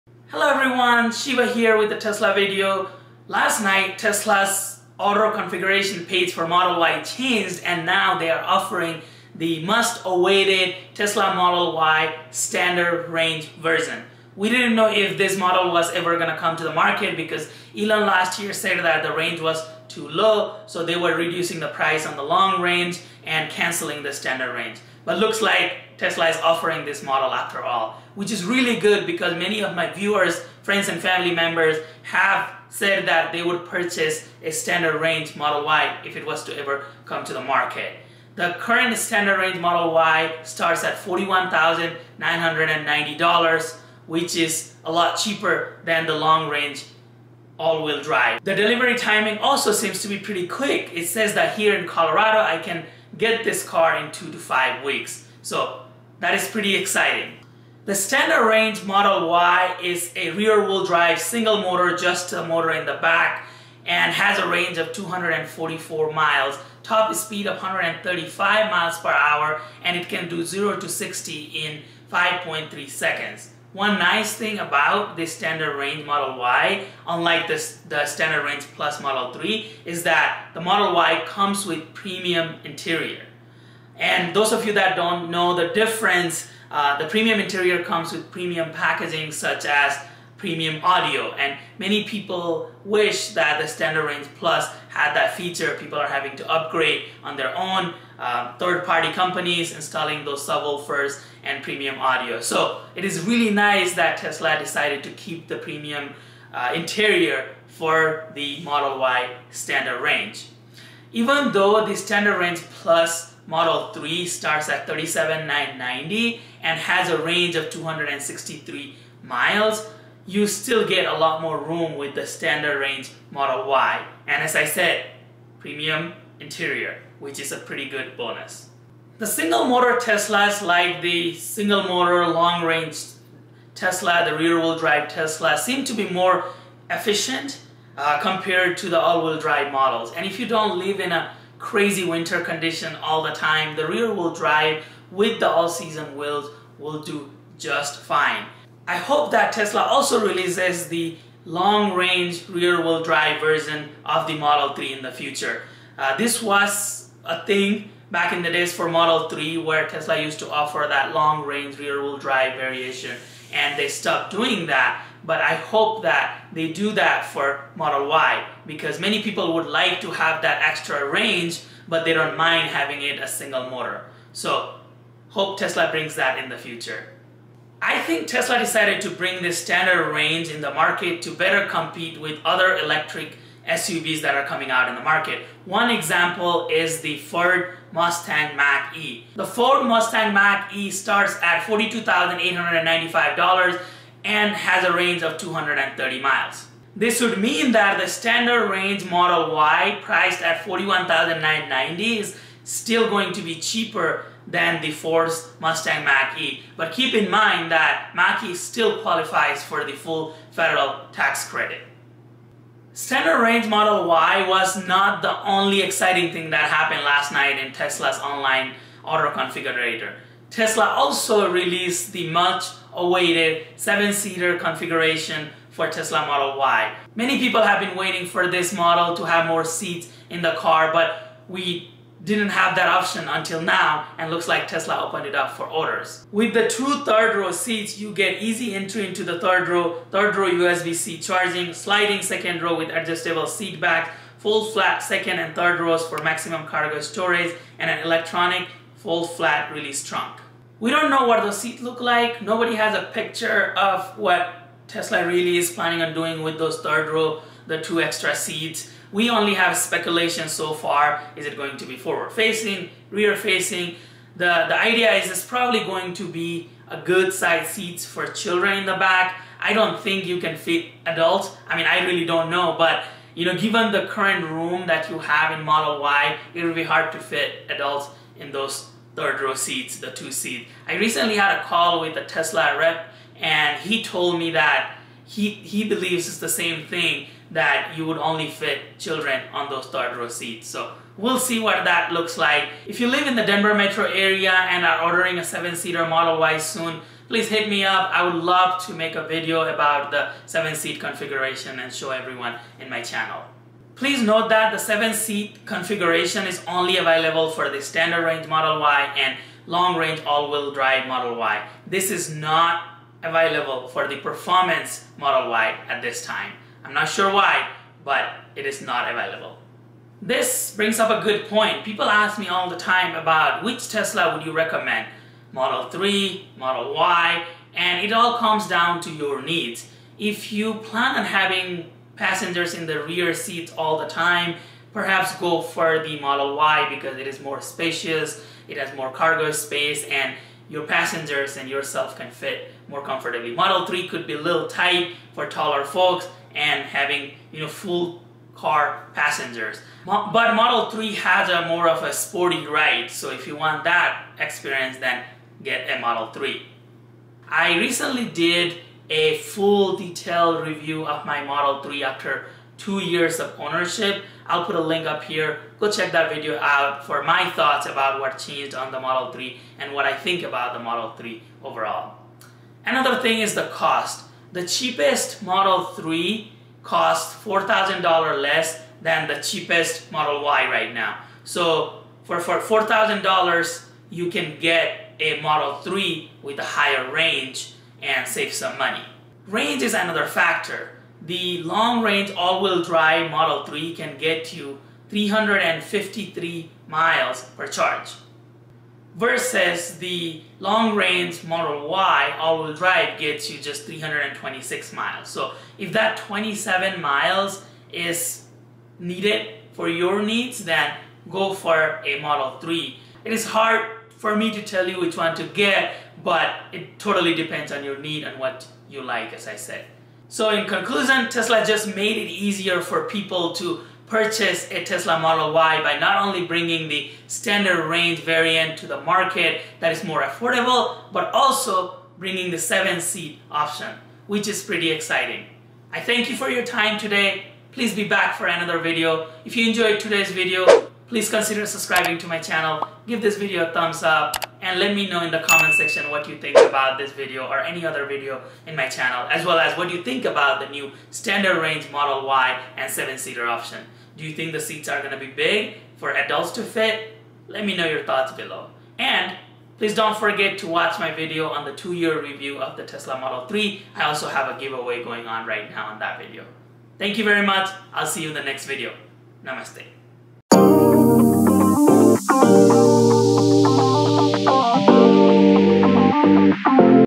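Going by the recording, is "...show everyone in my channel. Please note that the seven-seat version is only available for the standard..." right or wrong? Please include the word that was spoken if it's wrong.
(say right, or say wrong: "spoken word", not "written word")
wrong: "configuration", not "version".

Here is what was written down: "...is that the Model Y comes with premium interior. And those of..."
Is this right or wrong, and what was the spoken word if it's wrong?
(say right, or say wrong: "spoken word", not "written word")
right.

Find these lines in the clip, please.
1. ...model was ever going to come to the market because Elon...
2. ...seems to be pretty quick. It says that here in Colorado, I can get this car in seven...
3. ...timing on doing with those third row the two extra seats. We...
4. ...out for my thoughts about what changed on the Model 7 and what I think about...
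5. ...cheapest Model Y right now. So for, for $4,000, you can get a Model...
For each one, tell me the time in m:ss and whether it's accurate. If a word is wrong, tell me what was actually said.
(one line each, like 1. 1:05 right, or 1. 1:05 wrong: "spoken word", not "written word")
1. 0:15 right
2. 0:49 wrong: "two", not "seven"
3. 4:15 wrong: "planning", not "timing"
4. 6:06 wrong: "3", not "7"
5. 6:19 right.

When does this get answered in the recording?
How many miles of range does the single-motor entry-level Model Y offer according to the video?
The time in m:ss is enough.
1:04.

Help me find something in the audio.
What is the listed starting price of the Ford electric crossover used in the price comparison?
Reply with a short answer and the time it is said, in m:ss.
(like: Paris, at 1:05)
$42,895, at 3:11.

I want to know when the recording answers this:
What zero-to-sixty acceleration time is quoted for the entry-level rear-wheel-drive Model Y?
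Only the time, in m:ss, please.
1:12.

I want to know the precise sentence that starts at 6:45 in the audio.
So if that 27 miles is needed for your needs, then go for a Model 3.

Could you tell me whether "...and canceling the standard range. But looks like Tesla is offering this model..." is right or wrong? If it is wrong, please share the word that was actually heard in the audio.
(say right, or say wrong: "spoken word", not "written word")
right.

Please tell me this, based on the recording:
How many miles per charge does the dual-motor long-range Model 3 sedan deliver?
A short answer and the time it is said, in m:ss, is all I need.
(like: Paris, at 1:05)
353 miles, at 6:35.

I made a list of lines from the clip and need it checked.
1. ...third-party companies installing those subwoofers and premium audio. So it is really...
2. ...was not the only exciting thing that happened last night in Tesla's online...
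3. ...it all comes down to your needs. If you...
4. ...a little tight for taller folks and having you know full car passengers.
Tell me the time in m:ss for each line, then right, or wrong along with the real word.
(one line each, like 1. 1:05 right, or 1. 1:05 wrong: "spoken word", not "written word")
1. 1:38 right
2. 3:34 right
3. 5:28 right
4. 5:44 right.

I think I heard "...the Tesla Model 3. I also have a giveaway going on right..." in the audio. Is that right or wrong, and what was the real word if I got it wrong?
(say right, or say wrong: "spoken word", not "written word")
right.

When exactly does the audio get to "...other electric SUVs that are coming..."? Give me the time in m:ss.
3:02.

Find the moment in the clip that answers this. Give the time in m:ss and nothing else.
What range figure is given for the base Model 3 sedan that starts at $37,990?
1:57.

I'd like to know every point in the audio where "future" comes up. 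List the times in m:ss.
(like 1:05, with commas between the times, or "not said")
2:35, 2:56.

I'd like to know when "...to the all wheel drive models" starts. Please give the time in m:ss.
2:18.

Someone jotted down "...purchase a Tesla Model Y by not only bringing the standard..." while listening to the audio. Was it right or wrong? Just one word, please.
right.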